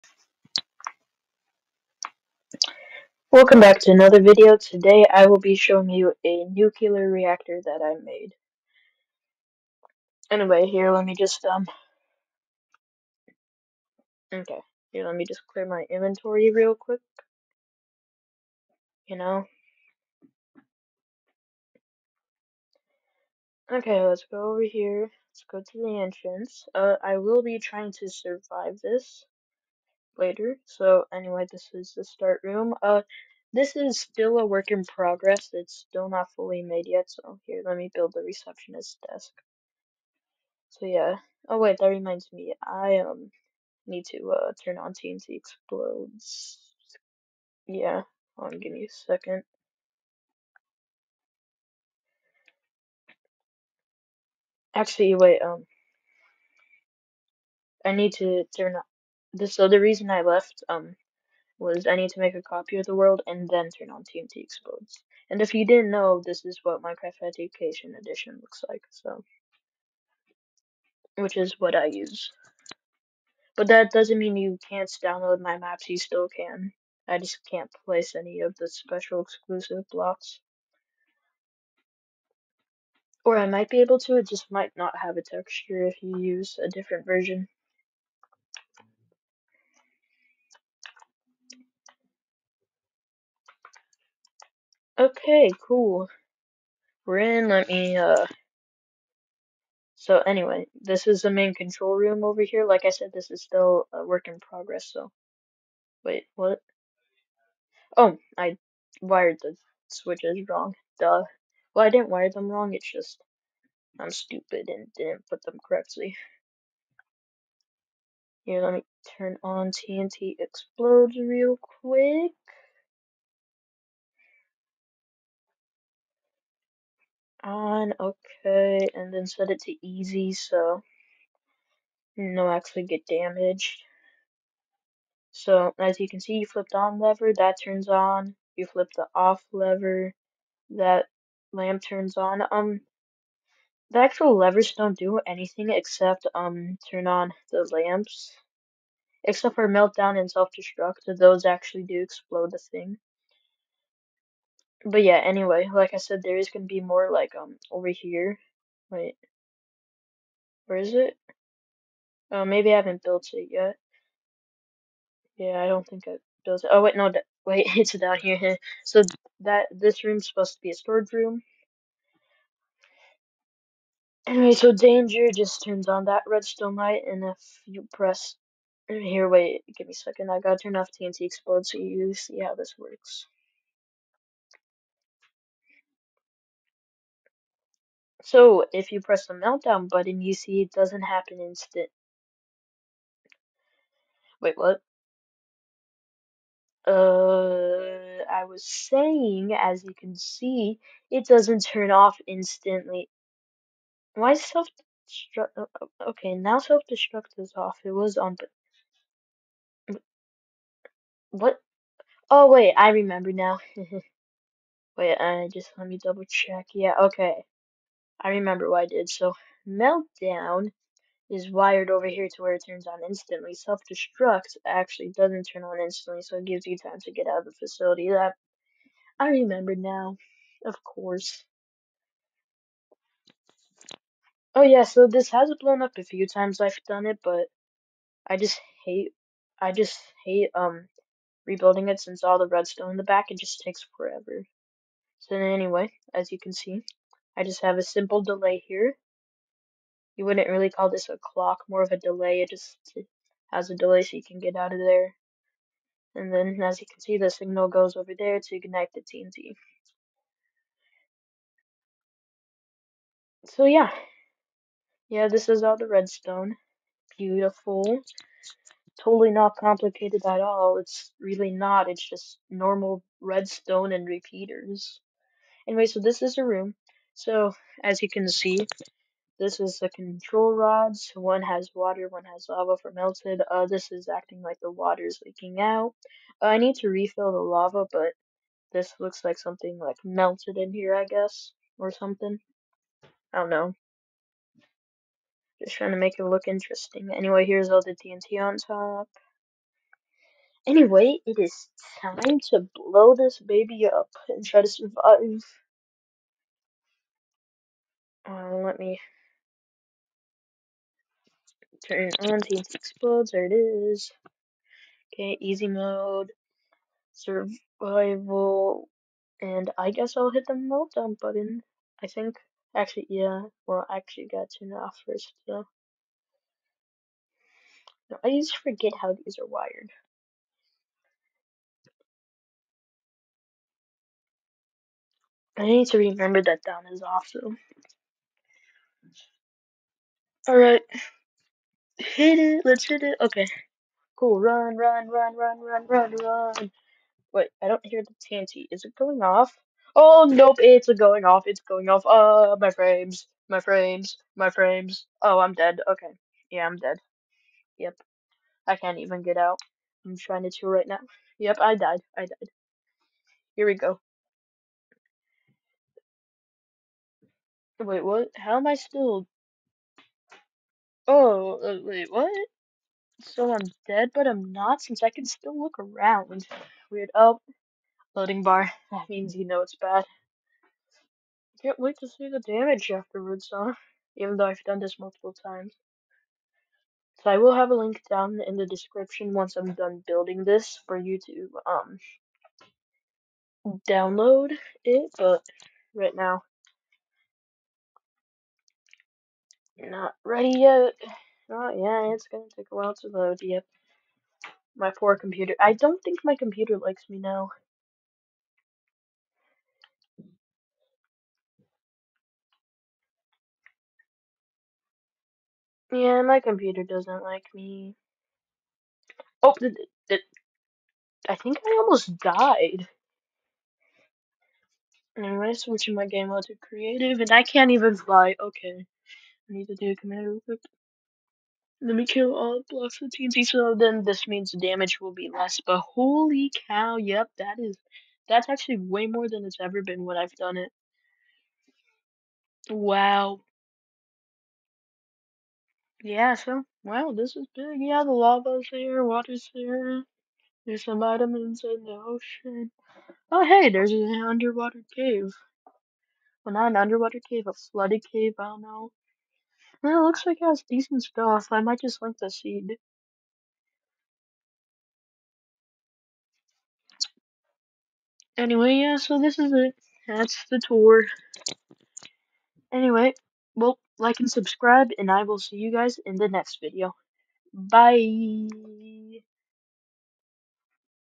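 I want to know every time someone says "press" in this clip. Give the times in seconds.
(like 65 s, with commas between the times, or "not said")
177 s, 189 s.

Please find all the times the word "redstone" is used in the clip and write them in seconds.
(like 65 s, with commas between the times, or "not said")
176 s, 242 s, 265 s, 273 s.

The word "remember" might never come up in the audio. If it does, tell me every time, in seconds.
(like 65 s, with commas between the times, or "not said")
212 s, 218 s, 229 s, 335 s.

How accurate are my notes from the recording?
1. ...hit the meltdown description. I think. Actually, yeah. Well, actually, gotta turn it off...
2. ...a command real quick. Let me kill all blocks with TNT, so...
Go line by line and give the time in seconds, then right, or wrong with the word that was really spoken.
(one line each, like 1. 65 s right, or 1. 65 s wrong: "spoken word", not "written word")
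1. 320 s wrong: "button", not "description"
2. 429 s right.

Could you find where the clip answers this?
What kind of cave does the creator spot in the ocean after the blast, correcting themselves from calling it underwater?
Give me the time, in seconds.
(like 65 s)
457 s.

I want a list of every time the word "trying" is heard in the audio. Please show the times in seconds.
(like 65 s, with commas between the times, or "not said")
27 s, 295 s, 360 s.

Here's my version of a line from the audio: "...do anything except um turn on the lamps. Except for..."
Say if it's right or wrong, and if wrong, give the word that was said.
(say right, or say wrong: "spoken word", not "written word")
right.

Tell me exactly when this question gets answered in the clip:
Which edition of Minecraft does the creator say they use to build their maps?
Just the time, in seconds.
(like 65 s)
66 s.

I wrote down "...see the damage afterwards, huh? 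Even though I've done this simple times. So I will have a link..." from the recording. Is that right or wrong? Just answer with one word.
wrong.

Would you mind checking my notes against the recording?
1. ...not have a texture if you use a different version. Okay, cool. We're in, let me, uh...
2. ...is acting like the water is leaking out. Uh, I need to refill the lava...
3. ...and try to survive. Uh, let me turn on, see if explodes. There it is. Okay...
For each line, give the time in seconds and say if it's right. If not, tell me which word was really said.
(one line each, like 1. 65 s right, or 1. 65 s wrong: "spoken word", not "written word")
1. 84 s right
2. 283 s right
3. 304 s right.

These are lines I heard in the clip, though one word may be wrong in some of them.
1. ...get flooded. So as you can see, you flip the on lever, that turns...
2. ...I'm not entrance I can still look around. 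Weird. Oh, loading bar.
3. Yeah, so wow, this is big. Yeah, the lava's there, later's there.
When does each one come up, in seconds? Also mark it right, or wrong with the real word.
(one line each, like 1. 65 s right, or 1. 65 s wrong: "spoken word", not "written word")
1. 132 s wrong: "damaged", not "flooded"
2. 374 s wrong: "since", not "entrance"
3. 446 s wrong: "water", not "later".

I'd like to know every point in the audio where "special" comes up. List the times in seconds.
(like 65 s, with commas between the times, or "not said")
78 s.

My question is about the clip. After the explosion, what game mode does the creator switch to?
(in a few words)
Creative.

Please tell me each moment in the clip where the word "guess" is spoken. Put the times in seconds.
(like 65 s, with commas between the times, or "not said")
291 s, 319 s.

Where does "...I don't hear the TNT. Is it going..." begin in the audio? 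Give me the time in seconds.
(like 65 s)
347 s.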